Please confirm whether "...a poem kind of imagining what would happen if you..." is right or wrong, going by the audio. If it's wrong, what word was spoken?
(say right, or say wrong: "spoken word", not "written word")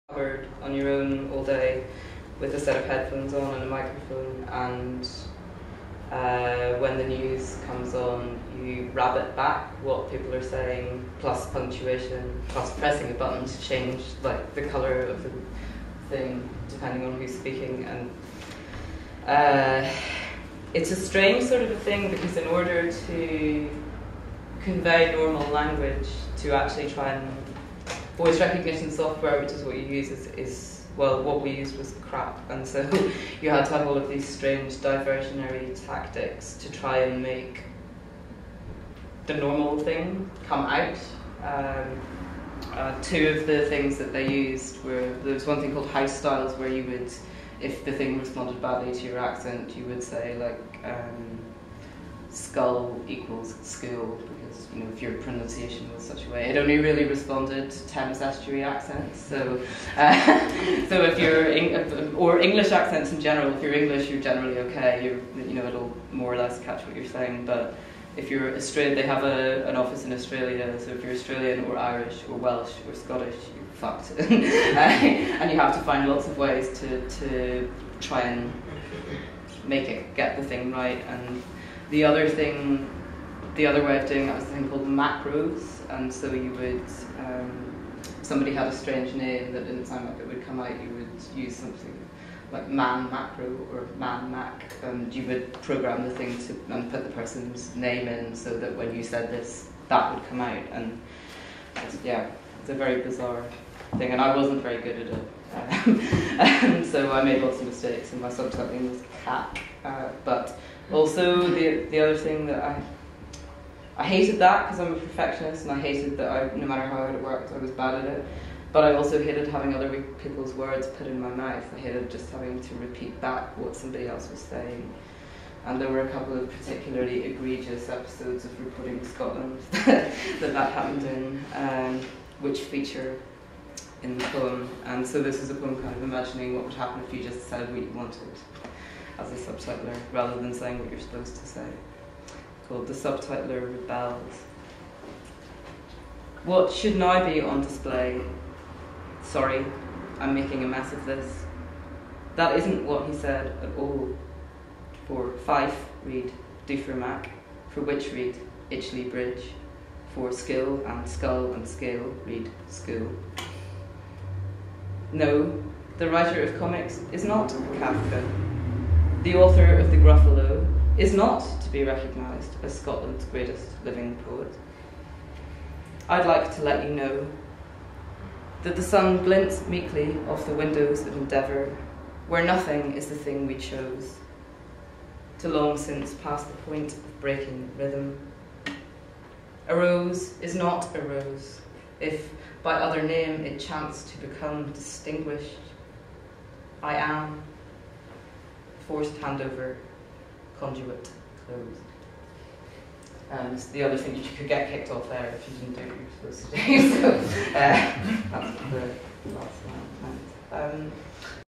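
right.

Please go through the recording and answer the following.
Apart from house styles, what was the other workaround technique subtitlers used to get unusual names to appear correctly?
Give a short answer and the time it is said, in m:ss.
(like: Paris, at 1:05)
Macros, at 1:24.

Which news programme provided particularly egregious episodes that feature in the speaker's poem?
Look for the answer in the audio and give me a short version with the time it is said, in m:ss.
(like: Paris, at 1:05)
Reporting Scotland, at 2:08.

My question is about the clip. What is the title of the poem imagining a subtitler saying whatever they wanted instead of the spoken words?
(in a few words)
The Subtitler Rebels.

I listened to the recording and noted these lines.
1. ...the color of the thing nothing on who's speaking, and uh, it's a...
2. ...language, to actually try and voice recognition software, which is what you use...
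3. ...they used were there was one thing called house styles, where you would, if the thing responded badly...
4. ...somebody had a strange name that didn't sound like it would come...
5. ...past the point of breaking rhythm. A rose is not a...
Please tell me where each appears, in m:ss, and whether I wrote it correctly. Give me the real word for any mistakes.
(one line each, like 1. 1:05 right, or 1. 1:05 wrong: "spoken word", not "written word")
1. 0:14 wrong: "depending", not "nothing"
2. 0:25 right
3. 0:44 right
4. 1:28 right
5. 3:06 right.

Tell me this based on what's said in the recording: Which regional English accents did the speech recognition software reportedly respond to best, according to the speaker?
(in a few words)
Thames estuary accents.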